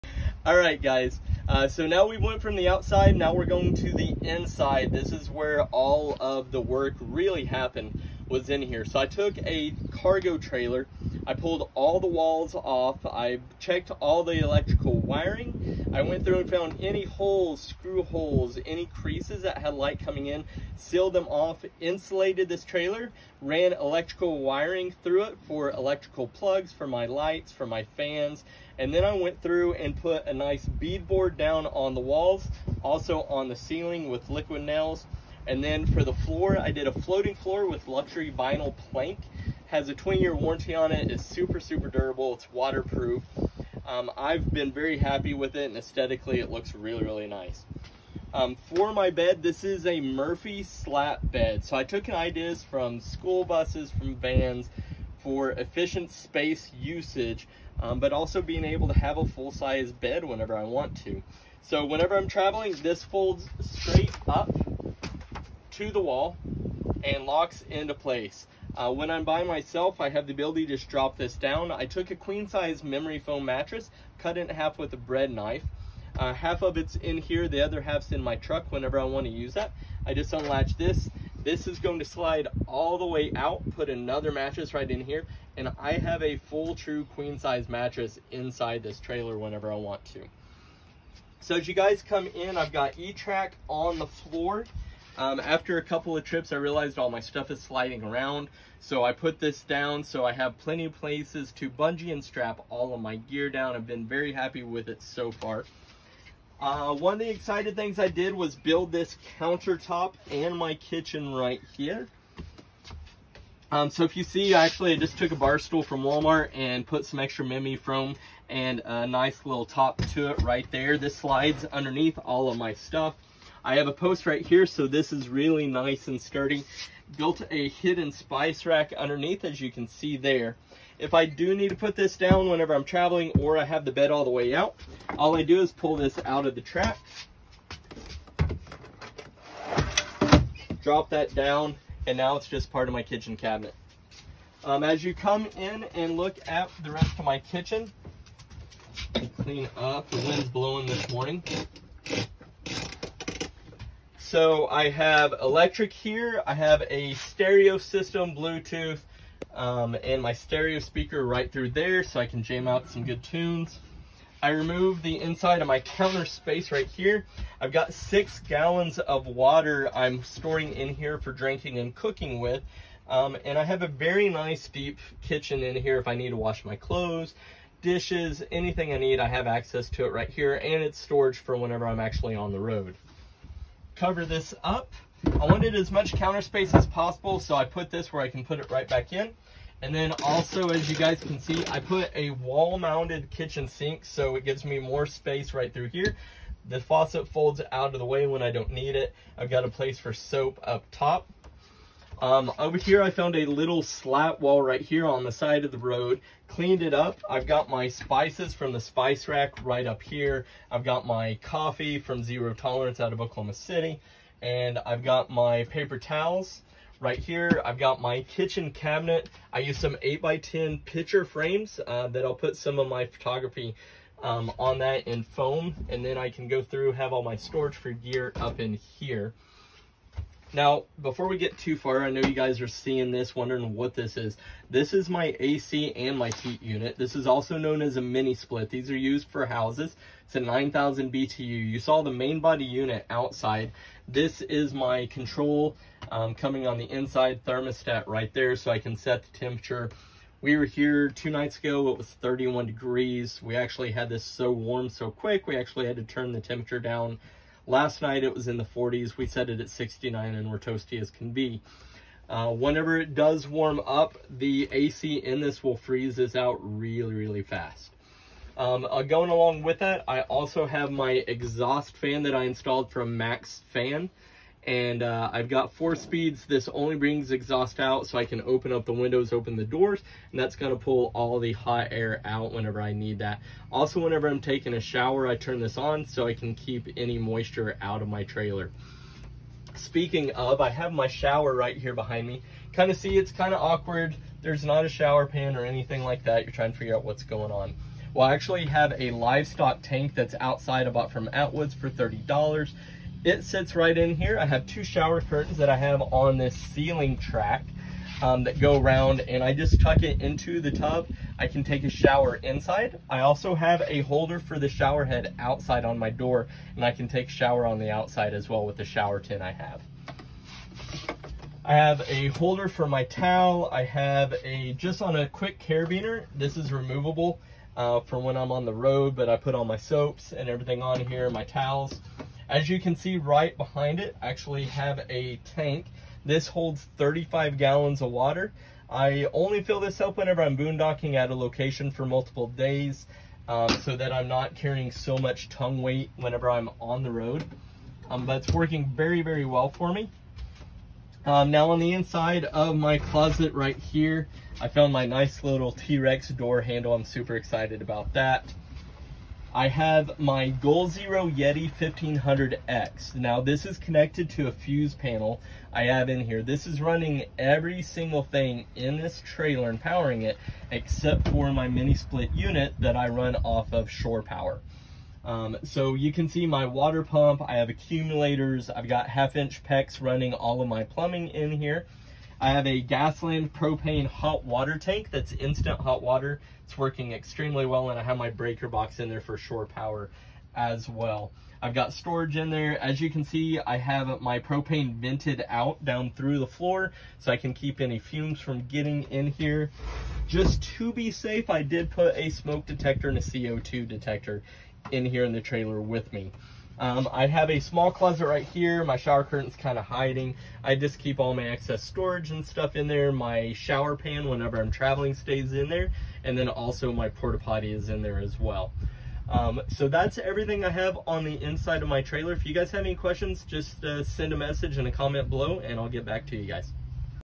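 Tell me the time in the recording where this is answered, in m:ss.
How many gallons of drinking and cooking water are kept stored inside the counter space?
2:47.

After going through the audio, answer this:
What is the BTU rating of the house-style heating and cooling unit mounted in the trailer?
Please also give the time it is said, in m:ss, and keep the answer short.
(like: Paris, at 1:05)
9,000, at 4:00.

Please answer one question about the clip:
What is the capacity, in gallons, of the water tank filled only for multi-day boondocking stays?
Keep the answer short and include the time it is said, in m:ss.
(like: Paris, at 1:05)
35, at 5:36.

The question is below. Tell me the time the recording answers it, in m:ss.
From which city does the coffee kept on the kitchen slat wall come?
3:33.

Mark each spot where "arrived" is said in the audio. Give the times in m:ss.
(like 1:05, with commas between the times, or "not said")
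not said.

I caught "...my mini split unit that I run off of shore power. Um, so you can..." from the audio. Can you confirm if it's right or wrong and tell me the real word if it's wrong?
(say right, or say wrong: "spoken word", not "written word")
right.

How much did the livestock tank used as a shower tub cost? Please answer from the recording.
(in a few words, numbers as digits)
$30.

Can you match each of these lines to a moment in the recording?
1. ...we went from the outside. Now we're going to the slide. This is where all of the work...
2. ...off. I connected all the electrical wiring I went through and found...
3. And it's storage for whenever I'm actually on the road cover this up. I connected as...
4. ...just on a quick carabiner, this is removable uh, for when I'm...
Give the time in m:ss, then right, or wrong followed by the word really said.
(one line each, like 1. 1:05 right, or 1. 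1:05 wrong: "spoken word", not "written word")
1. 0:02 wrong: "inside", not "slide"
2. 0:12 wrong: "checked", not "connected"
3. 3:00 wrong: "wanted", not "connected"
4. 5:24 right.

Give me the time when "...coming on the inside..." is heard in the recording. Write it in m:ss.
4:06.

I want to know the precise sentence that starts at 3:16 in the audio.
The faucet folds out of the way when I don't need it.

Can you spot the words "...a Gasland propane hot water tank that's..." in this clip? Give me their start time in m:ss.
6:22.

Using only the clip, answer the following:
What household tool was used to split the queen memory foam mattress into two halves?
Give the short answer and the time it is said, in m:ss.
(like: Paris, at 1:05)
Bread knife, at 1:14.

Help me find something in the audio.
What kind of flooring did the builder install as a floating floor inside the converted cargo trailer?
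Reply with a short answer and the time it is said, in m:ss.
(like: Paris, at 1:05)
Luxury vinyl plank, at 0:37.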